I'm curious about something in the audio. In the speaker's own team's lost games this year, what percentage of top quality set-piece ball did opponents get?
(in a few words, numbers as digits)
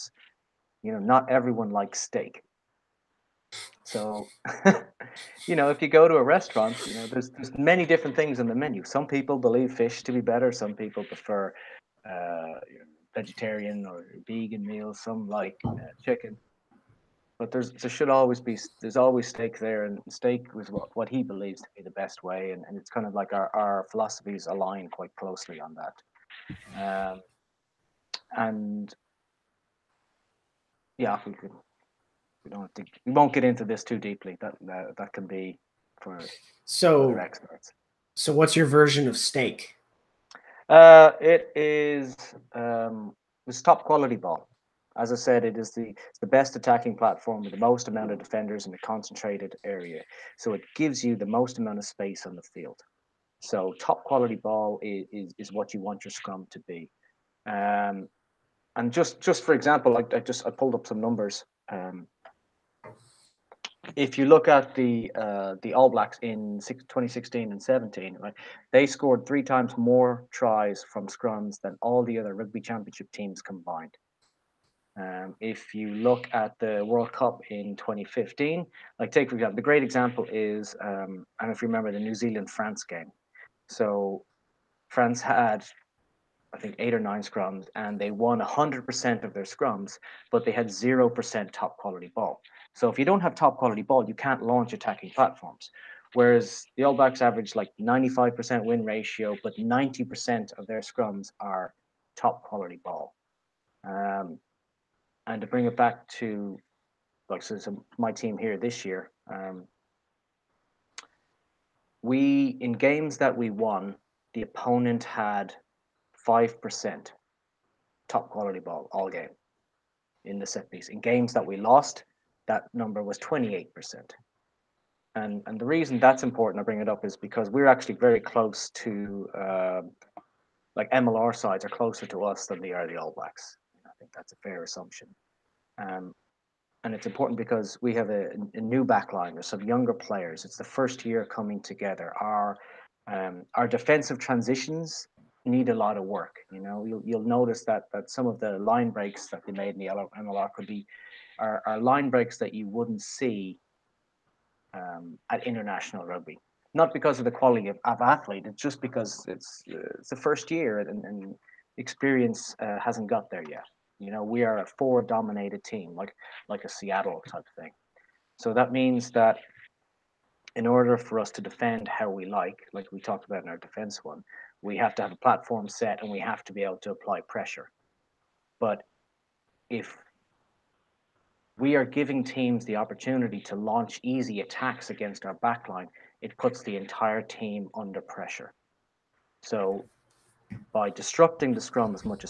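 28%.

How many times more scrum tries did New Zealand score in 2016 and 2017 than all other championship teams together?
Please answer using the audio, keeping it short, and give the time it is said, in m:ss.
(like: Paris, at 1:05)
3, at 1:09.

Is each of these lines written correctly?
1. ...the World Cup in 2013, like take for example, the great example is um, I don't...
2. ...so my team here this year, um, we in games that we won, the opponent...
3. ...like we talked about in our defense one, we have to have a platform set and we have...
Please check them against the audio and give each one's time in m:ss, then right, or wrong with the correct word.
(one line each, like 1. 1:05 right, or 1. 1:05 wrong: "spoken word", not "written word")
1. 1:16 wrong: "2015", not "2013"
2. 1:47 right
3. 2:52 right.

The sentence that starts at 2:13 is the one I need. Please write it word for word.
I think that's a fair assumption.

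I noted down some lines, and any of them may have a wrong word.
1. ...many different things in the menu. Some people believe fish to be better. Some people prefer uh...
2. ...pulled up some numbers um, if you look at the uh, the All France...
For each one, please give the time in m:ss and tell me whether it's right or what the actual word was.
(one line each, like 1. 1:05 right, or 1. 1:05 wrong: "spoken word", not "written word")
1. 0:07 right
2. 1:00 wrong: "Blacks", not "France".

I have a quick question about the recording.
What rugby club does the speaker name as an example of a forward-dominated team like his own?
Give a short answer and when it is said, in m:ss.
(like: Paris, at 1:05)
Seattle, at 2:46.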